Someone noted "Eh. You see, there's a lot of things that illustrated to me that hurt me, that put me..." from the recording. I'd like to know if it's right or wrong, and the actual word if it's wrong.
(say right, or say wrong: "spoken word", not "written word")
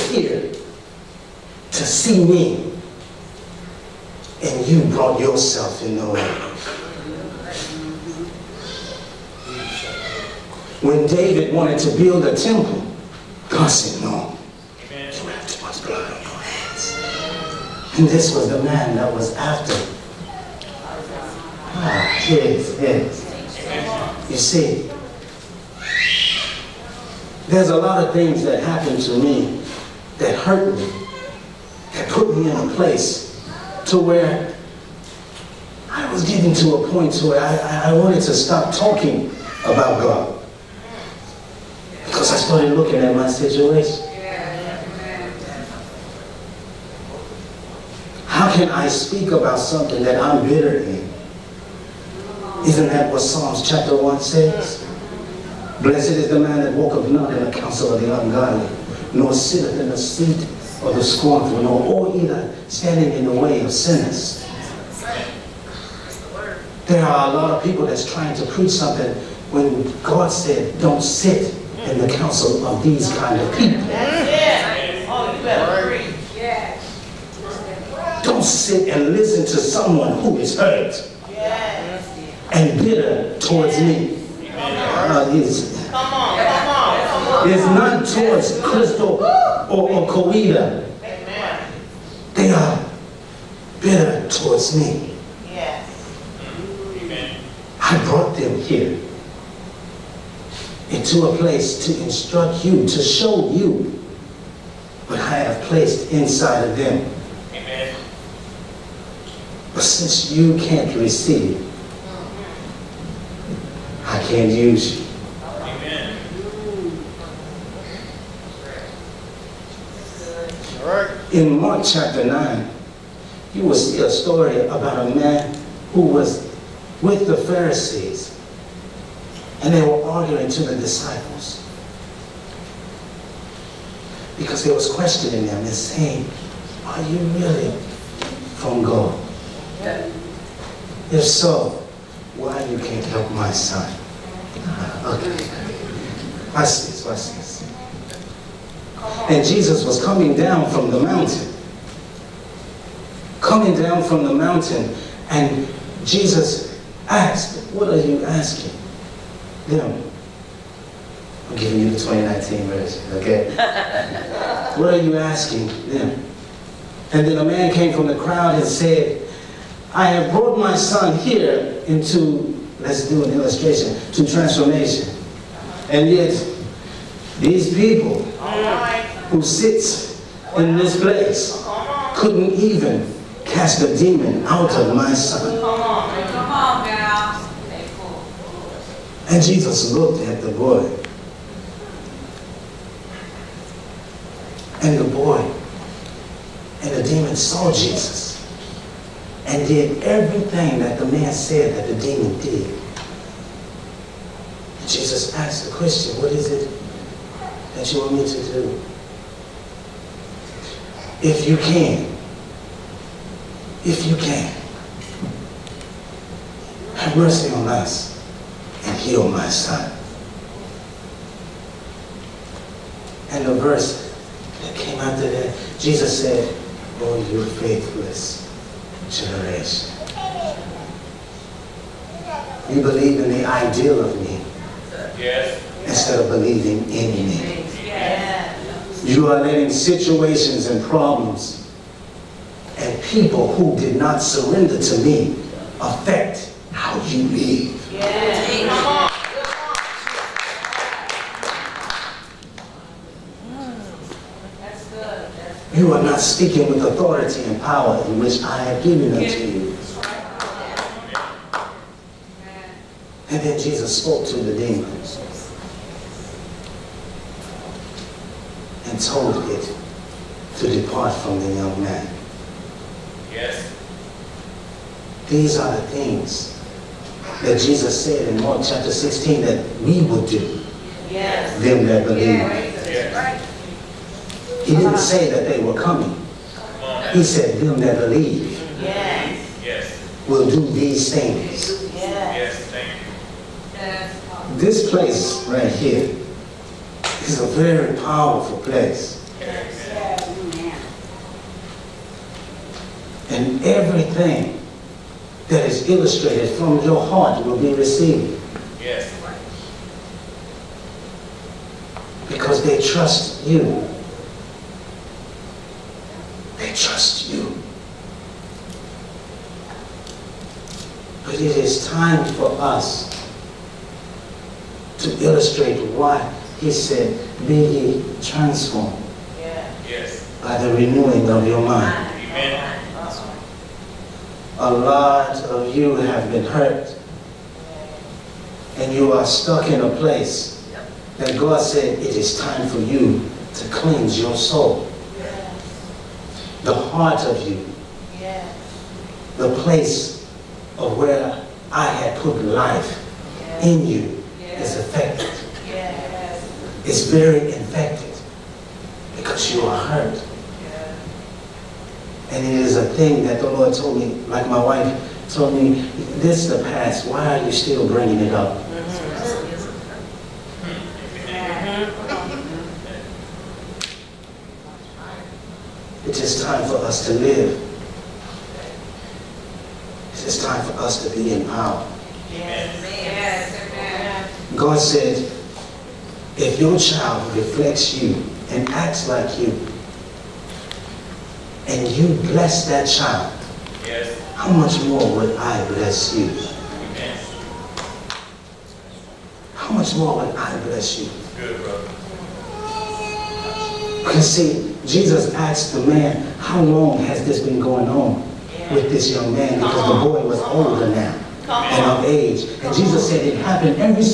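wrong: "happened", not "illustrated".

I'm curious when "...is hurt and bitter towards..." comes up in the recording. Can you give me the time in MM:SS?
01:20.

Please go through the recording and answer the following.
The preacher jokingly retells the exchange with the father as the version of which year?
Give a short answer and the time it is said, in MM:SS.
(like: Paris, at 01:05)
2019, at 02:41.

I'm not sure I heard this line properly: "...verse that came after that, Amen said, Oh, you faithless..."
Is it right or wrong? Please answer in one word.
wrong.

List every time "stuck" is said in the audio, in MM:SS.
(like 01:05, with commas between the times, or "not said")
05:39.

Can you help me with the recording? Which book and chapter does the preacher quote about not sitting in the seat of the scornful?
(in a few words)
Psalms chapter 1.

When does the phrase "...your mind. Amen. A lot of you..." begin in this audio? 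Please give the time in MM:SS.
05:31.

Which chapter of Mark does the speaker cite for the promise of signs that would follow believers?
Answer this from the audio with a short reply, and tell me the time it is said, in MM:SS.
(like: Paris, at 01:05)
Mark chapter 16, at 04:38.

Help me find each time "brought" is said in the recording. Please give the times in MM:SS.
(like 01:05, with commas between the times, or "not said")
00:04, 01:38, 02:50.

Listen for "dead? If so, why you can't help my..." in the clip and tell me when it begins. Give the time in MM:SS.
02:19.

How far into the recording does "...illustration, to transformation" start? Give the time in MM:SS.
02:53.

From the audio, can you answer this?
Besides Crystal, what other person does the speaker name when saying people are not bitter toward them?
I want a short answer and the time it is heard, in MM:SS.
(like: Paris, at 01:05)
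Kawita, at 01:30.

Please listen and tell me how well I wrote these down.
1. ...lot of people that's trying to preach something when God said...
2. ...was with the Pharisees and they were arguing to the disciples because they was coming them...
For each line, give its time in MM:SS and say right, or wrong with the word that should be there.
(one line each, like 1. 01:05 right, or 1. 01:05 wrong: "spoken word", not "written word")
1. 01:07 right
2. 02:06 wrong: "questioning", not "coming".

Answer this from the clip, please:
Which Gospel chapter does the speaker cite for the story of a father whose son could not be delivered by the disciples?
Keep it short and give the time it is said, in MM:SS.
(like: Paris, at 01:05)
Mark chapter 9, at 02:01.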